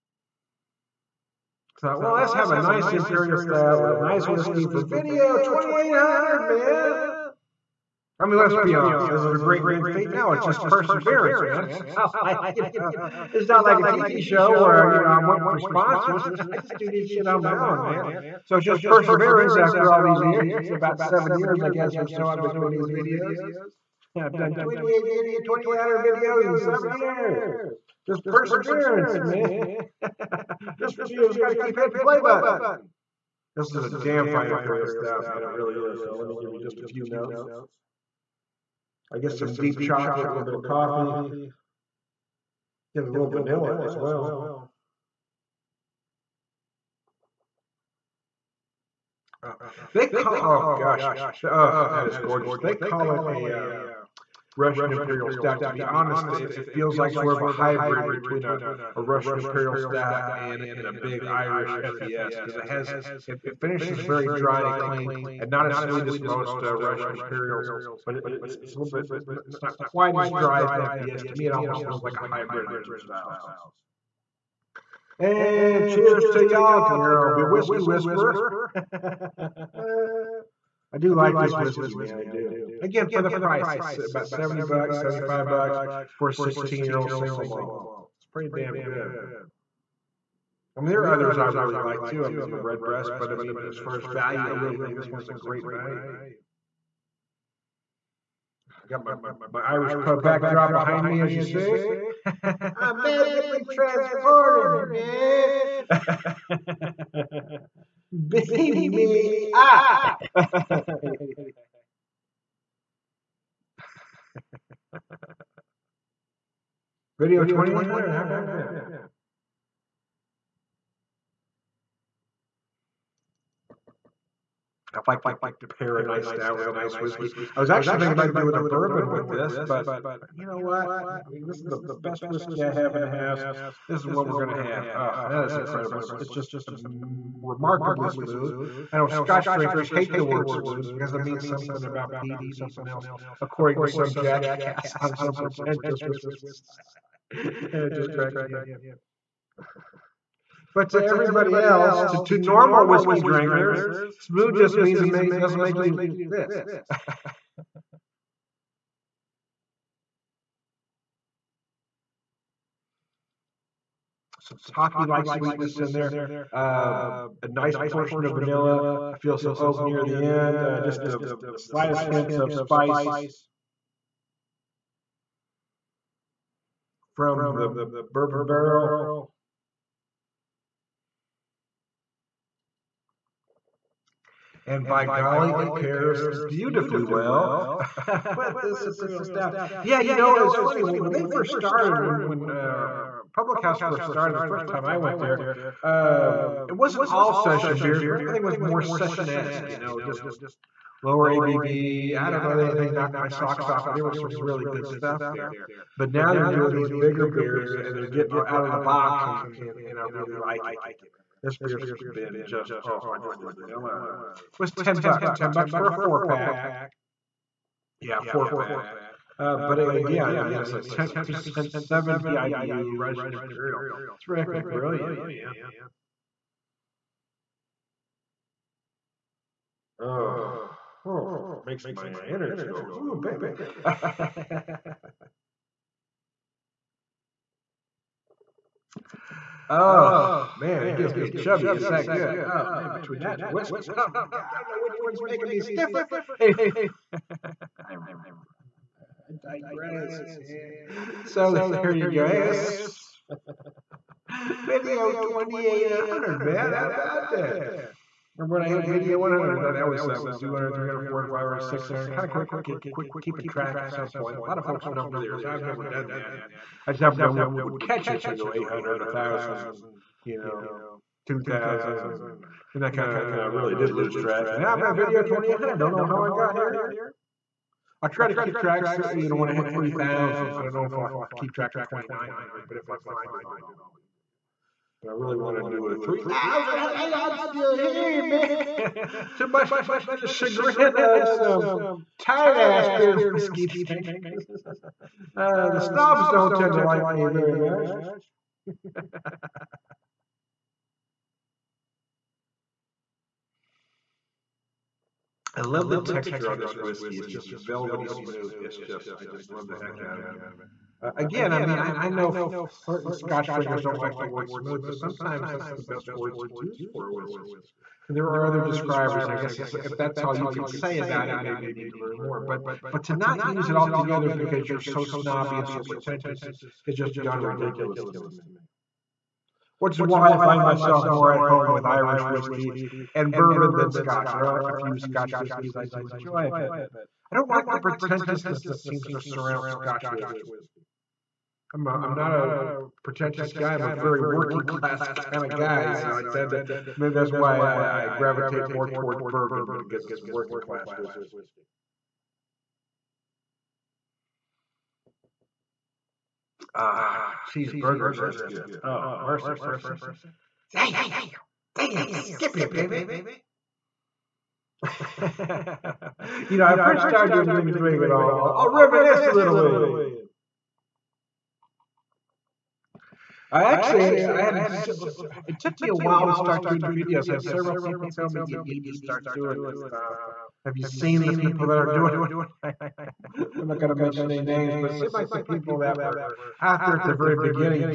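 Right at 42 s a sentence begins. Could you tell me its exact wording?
Get a little vanilla as well.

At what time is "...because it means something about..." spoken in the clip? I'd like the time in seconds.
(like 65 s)
140 s.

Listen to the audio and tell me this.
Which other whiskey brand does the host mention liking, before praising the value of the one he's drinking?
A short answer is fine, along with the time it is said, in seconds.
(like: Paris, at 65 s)
Redbreast, at 92 s.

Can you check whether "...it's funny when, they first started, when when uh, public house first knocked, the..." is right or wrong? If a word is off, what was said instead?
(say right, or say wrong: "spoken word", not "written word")
wrong: "started", not "knocked".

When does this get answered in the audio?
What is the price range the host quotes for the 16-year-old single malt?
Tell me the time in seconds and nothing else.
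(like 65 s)
84 s.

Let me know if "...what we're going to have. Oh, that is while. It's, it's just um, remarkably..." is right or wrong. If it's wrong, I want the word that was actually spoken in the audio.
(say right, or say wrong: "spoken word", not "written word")
wrong: "incredible", not "while".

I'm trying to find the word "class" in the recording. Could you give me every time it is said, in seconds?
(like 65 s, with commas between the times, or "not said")
344 s, 350 s.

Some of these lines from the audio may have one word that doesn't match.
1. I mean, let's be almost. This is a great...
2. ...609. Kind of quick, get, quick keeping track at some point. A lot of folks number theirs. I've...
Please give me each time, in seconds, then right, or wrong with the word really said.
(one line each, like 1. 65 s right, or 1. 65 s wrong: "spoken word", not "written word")
1. 8 s wrong: "honest", not "almost"
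2. 261 s wrong: "600", not "609".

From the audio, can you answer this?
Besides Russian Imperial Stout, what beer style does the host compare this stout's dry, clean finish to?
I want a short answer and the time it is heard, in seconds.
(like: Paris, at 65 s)
Irish FES, at 61 s.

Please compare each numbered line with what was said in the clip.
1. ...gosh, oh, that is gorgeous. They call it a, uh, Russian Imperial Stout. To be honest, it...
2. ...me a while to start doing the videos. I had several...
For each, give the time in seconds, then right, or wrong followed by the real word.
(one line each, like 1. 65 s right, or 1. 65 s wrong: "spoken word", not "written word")
1. 50 s right
2. 375 s right.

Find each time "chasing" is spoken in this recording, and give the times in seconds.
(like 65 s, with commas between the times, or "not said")
not said.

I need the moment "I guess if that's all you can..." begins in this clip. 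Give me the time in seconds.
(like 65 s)
319 s.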